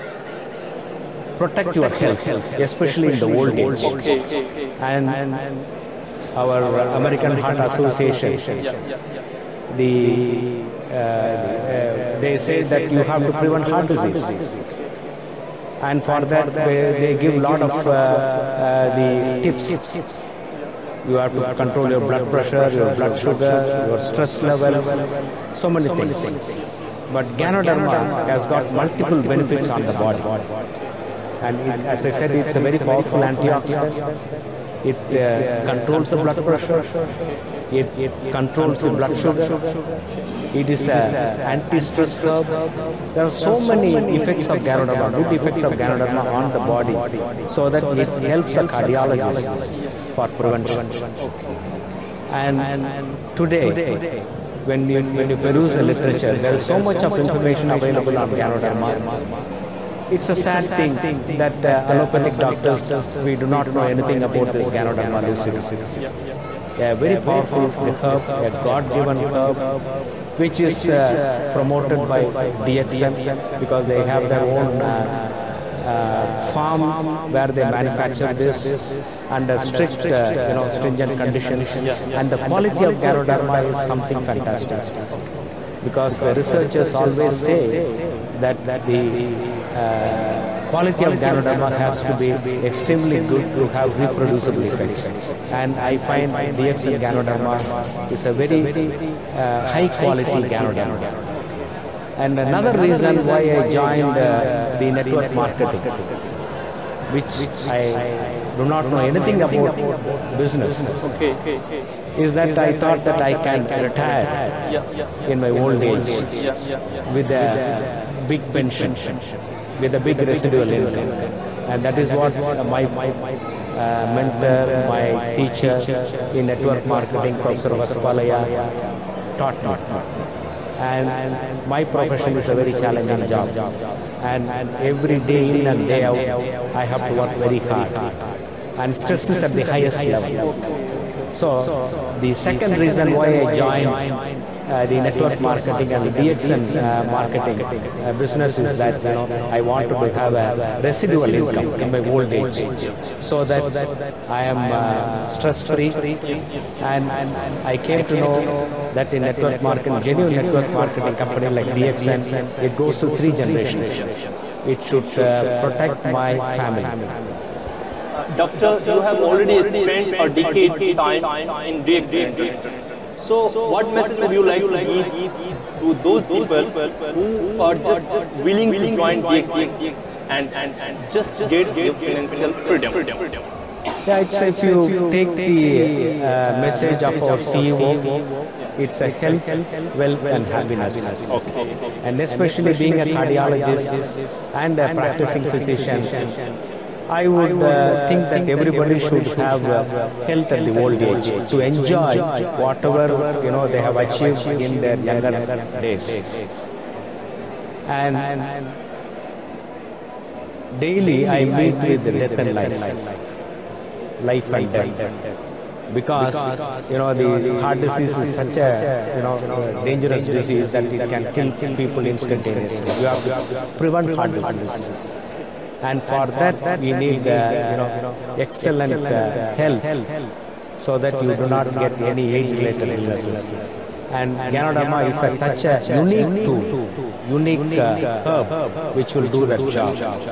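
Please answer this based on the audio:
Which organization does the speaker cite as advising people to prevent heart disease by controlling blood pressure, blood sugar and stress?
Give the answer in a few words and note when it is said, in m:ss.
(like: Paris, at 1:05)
American Heart Association, at 0:06.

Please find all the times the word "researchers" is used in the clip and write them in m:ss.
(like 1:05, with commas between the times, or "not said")
1:26.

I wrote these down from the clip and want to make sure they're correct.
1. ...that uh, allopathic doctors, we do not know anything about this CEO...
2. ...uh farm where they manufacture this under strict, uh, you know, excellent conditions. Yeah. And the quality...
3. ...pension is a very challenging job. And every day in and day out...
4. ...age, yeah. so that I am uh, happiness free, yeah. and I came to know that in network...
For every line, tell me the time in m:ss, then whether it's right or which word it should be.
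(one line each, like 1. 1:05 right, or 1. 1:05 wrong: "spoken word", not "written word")
1. 1:01 wrong: "Ganoderma", not "CEO"
2. 1:15 wrong: "stringent", not "excellent"
3. 2:11 wrong: "profession", not "pension"
4. 2:32 wrong: "stress", not "happiness".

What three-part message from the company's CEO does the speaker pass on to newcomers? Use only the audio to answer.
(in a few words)
health, wealth and happiness.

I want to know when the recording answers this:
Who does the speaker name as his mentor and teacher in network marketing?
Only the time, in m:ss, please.
2:07.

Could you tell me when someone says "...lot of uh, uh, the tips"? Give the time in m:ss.
0:17.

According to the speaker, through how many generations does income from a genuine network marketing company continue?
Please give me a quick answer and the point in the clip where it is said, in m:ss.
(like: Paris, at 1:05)
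3, at 2:43.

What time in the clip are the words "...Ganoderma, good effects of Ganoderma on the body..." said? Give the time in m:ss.
0:44.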